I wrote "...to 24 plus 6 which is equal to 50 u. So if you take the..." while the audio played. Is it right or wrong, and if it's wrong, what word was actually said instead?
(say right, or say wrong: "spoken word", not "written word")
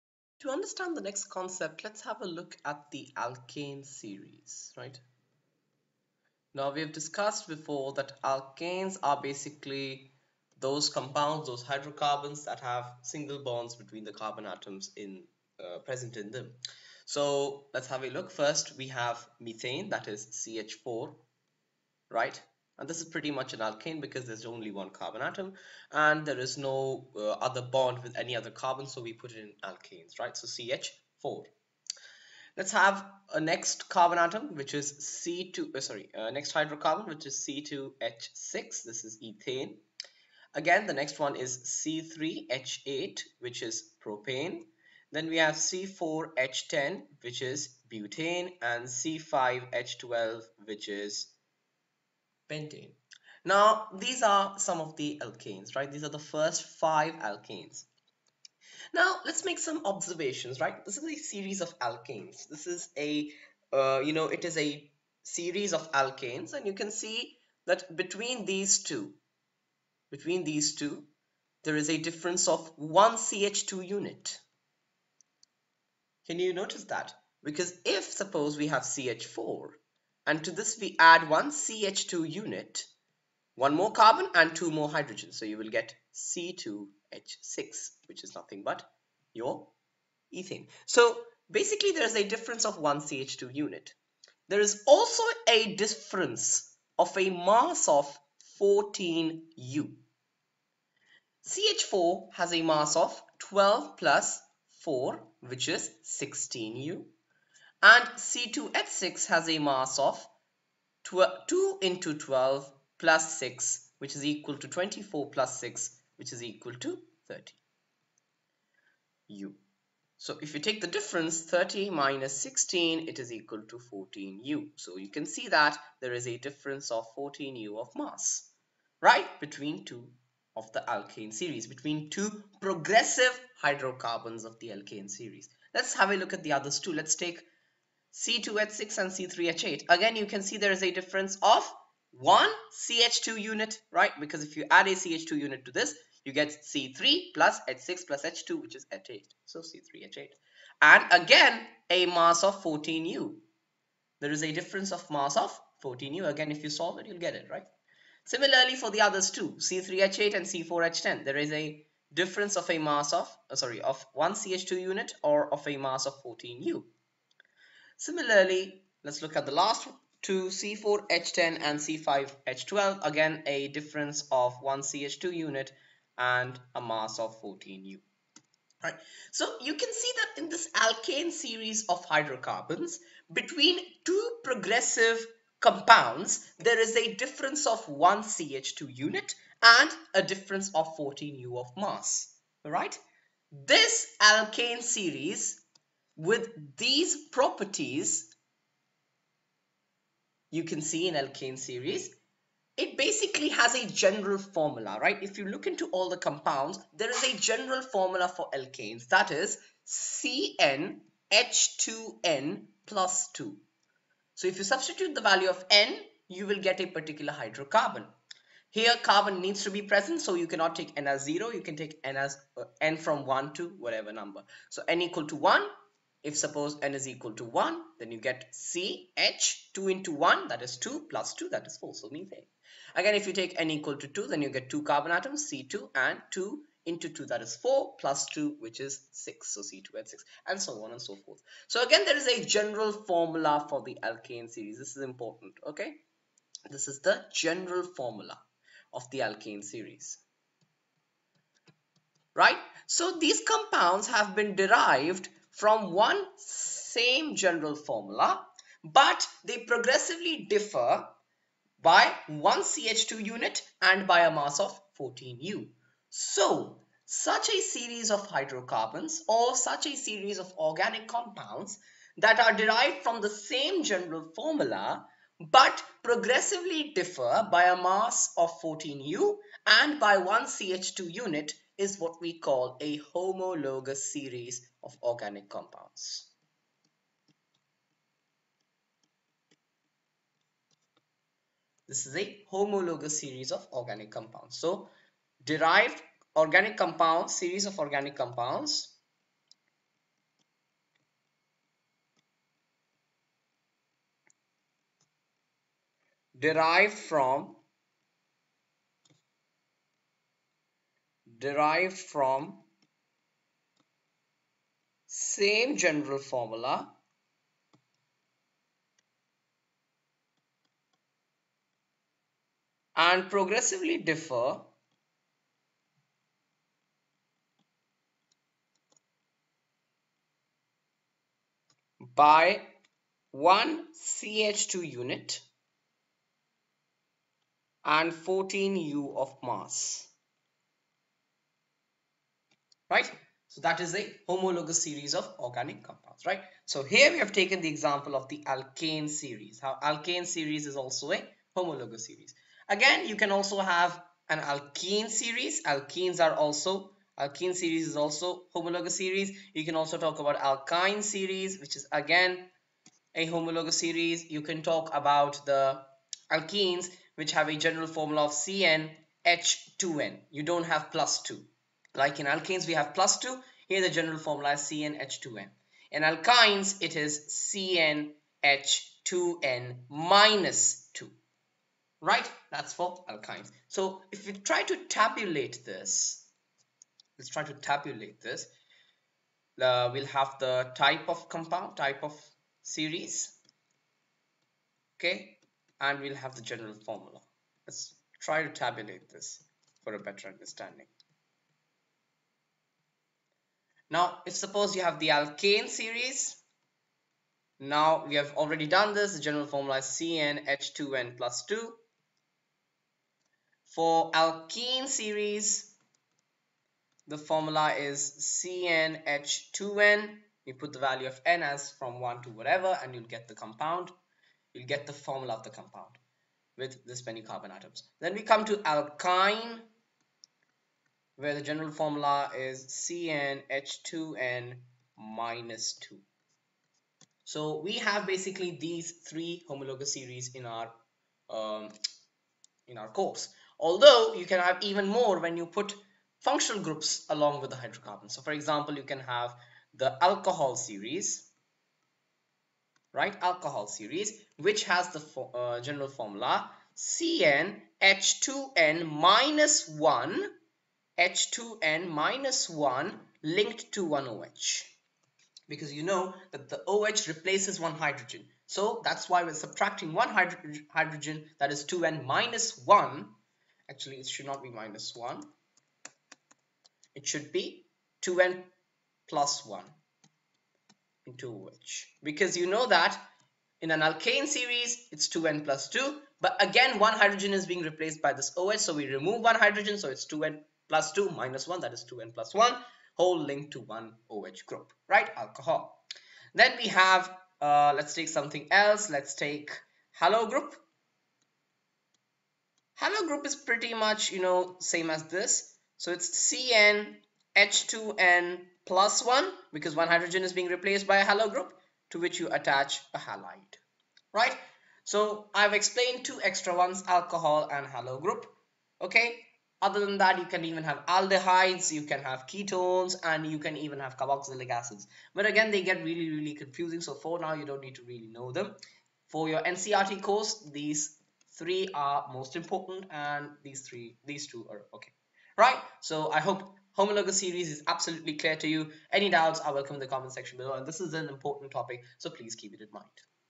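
wrong: "30", not "50".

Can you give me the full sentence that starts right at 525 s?
But again, they get really, really confusing.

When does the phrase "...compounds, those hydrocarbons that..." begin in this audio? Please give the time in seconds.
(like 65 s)
10 s.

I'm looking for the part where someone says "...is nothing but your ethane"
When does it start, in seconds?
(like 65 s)
88 s.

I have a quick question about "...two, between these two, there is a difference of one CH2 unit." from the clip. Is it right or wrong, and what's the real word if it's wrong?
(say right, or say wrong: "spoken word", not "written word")
right.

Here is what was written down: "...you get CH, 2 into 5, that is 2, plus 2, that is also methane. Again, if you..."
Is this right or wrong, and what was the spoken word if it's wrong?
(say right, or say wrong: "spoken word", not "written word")
wrong: "1", not "5".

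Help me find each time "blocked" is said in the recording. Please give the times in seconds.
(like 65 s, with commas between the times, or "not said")
not said.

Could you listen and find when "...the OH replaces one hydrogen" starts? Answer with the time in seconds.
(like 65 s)
466 s.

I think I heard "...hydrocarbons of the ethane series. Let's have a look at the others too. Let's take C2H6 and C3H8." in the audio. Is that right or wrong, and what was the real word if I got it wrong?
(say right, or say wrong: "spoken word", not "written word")
wrong: "alkane", not "ethane".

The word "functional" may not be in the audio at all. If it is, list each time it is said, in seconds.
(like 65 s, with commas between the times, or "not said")
446 s.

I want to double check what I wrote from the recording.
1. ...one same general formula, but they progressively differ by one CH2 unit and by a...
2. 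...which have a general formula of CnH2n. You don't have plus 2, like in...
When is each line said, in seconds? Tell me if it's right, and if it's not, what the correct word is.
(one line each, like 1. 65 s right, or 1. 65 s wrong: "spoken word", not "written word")
1. 255 s right
2. 367 s right.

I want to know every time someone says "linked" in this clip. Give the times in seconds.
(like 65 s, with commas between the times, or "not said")
463 s, 493 s.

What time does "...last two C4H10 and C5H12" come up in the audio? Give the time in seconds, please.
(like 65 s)
169 s.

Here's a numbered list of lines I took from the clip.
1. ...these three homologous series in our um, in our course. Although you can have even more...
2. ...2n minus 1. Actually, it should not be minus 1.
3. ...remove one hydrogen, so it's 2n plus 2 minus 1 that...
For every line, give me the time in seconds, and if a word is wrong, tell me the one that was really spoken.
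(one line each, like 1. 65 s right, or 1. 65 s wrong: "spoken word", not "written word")
1. 438 s right
2. 471 s right
3. 488 s right.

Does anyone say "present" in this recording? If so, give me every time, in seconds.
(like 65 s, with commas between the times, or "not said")
15 s, 219 s.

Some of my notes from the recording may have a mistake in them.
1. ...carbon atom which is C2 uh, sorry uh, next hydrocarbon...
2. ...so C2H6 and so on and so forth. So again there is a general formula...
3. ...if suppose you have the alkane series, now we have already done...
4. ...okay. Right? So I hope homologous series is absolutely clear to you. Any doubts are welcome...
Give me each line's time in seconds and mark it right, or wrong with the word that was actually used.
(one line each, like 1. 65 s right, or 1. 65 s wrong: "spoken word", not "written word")
1. 33 s right
2. 239 s right
3. 404 s right
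4. 534 s right.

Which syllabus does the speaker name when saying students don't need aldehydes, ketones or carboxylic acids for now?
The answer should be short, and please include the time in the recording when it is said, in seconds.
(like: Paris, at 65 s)
NCERT, at 529 s.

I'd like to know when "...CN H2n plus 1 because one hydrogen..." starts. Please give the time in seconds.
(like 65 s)
506 s.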